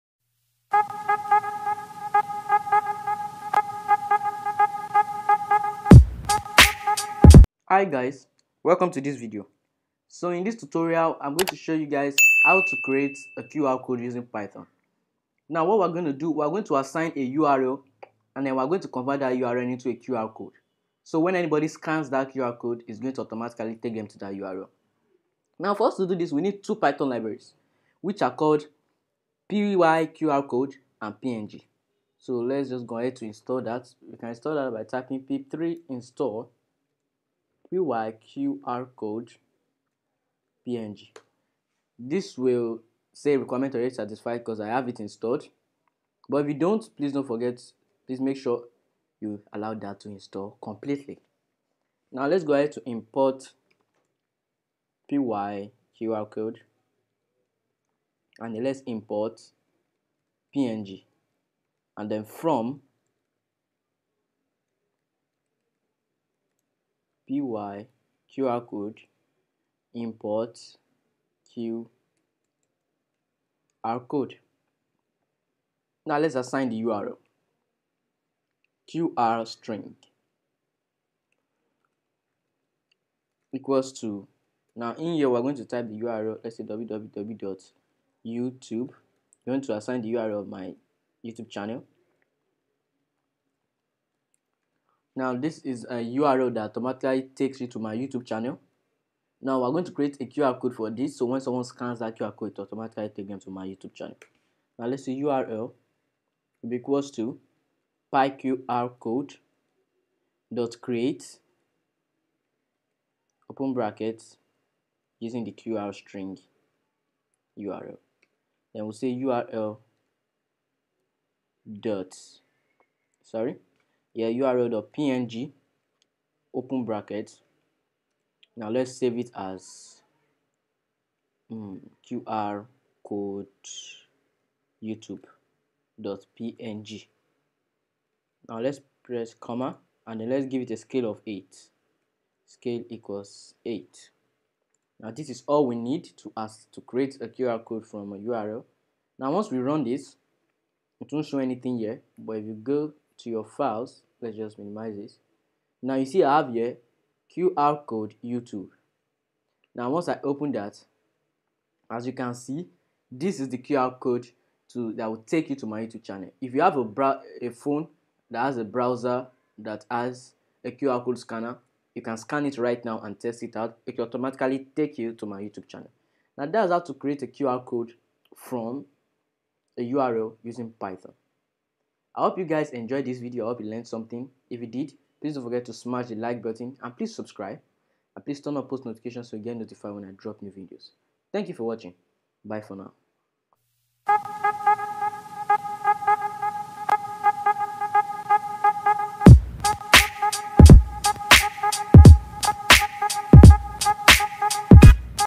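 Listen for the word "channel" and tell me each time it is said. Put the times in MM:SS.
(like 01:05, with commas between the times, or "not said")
01:31, 01:38, 01:43, 02:46, 02:55.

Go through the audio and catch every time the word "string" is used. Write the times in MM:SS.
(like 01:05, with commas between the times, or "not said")
01:19, 01:55.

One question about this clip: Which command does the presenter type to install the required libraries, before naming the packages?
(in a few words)
pip 3 install.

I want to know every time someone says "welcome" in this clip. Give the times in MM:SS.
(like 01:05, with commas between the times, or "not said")
00:08.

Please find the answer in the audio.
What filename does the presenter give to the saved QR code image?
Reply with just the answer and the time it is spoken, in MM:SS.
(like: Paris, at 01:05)
qr code youtube.png, at 02:12.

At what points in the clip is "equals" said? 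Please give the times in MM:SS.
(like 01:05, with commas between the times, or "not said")
01:23, 01:46, 02:22.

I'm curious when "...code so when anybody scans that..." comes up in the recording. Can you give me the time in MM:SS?
00:20.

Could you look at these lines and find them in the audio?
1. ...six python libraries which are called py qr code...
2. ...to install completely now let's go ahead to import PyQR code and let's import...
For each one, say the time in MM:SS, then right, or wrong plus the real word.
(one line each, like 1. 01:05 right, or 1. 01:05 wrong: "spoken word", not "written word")
1. 00:26 wrong: "two", not "six"
2. 00:49 right.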